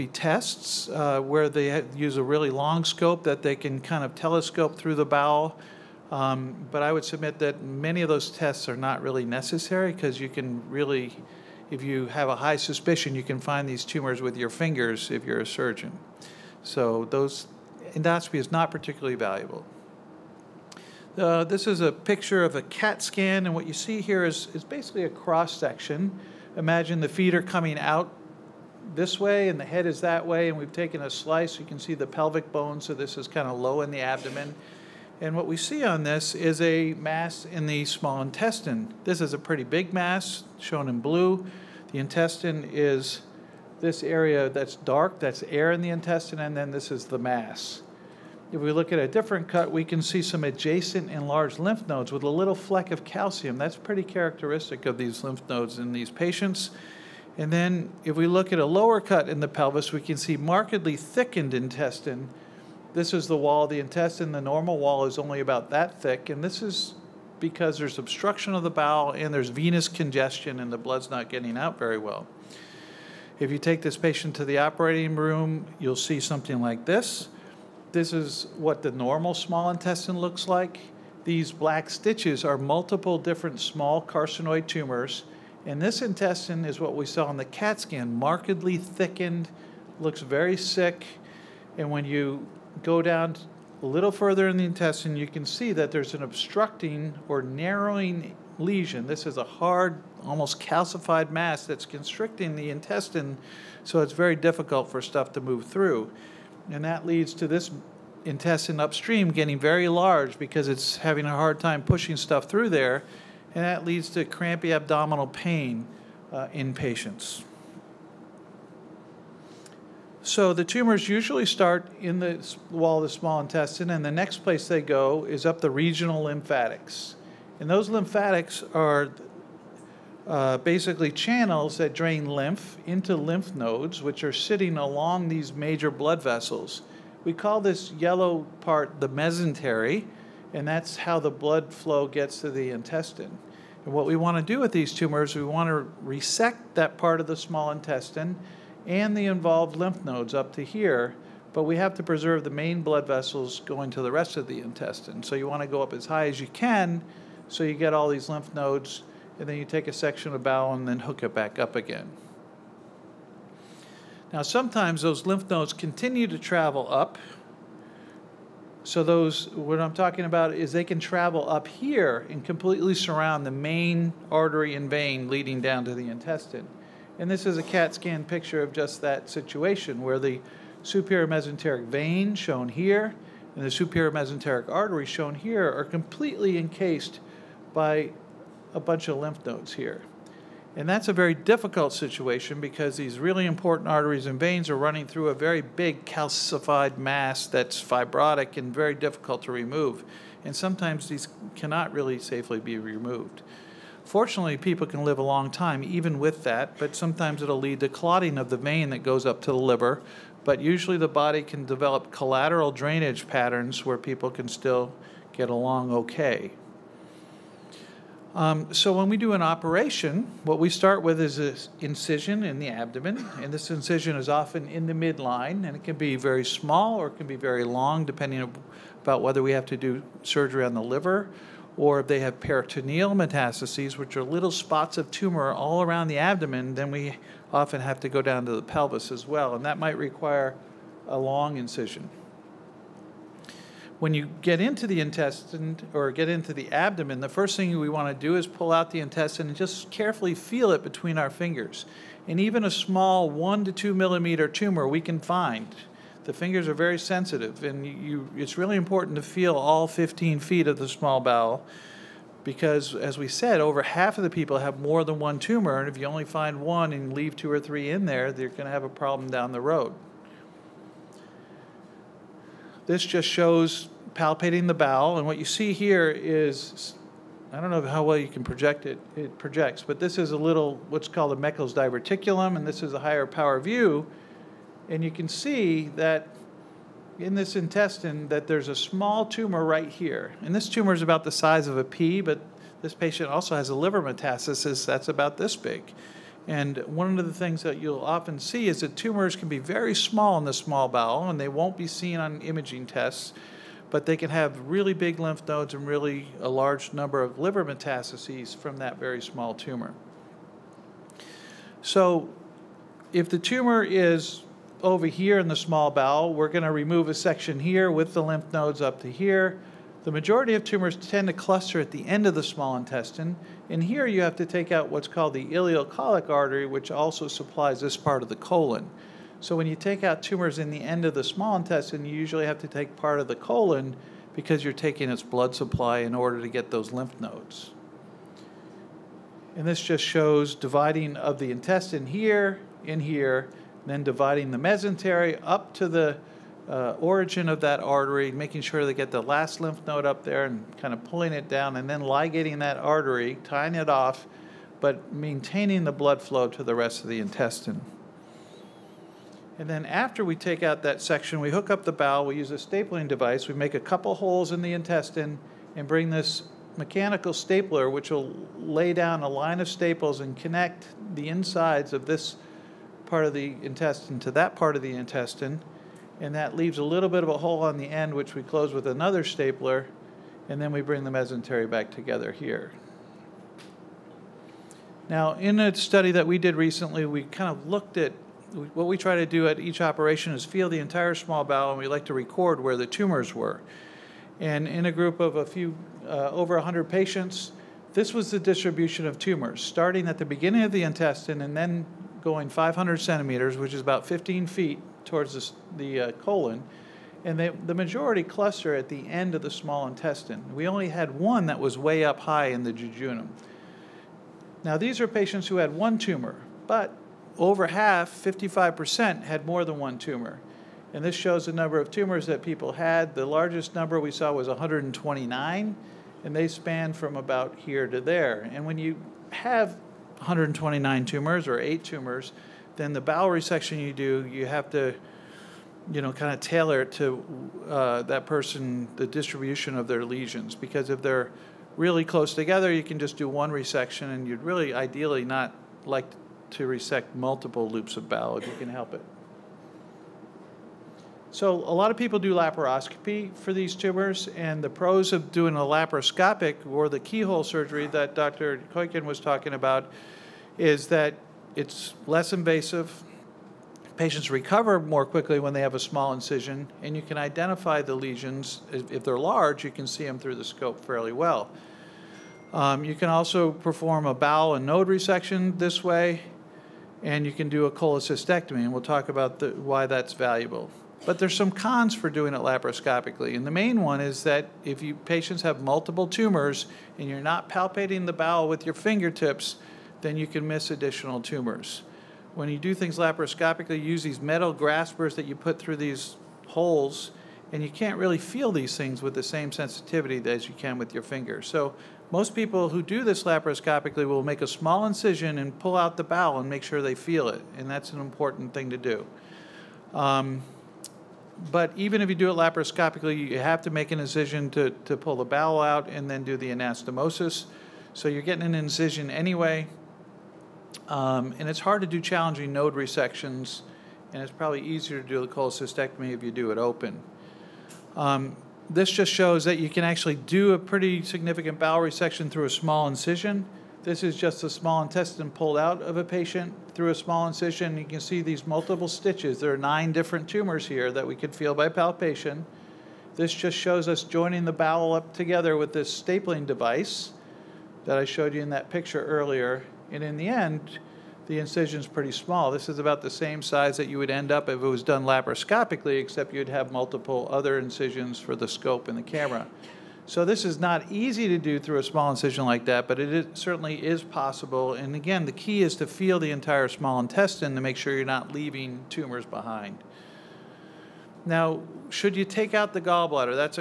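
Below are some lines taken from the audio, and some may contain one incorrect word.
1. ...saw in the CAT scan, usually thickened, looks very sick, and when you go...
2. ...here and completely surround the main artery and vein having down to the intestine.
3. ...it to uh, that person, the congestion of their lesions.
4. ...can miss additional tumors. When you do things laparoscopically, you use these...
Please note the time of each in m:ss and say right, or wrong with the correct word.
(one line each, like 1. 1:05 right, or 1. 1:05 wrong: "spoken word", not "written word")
1. 1:27 wrong: "markedly", not "usually"
2. 2:51 wrong: "leading", not "having"
3. 7:16 wrong: "distribution", not "congestion"
4. 8:10 right.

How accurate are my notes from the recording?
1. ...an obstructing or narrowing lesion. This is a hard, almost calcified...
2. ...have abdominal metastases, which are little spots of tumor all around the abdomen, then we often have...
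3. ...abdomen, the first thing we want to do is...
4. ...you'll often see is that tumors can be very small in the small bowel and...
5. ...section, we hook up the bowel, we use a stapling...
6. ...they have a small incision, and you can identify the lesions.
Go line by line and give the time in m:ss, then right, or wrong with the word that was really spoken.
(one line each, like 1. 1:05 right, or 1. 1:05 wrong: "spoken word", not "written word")
1. 1:36 right
2. 3:52 wrong: "peritoneal", not "abdominal"
3. 4:06 right
4. 4:57 right
5. 6:01 right
6. 7:45 right.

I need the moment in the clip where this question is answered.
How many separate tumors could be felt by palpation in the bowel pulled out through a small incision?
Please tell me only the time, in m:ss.
8:59.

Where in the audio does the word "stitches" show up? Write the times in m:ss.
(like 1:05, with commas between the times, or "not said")
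1:21, 8:58.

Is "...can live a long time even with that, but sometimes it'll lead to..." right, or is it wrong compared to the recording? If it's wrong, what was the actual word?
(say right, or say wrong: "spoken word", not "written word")
right.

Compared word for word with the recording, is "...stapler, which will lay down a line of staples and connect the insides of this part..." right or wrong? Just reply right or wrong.
right.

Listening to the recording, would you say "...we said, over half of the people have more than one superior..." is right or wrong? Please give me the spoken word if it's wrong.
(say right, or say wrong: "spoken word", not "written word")
wrong: "tumor", not "superior".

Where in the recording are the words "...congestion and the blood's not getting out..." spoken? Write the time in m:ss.
1:09.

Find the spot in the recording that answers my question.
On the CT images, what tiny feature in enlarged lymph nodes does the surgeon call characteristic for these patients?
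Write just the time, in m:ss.
0:52.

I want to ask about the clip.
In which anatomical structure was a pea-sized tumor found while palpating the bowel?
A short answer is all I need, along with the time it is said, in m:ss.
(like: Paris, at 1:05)
Meckel's diverticulum, at 4:41.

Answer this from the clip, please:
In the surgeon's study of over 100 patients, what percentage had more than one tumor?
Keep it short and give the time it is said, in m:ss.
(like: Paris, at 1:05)
55%, at 6:58.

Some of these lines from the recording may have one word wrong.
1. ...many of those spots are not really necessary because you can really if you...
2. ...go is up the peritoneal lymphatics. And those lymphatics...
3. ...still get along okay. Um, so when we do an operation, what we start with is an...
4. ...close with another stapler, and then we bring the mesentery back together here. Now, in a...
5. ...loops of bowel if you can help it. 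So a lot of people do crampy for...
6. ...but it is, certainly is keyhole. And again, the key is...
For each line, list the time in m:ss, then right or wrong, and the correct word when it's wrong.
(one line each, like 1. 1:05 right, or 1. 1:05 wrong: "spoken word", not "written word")
1. 0:07 wrong: "tests", not "spots"
2. 2:04 wrong: "regional", not "peritoneal"
3. 3:34 right
4. 6:18 right
5. 7:27 wrong: "laparoscopy", not "crampy"
6. 9:22 wrong: "possible", not "keyhole".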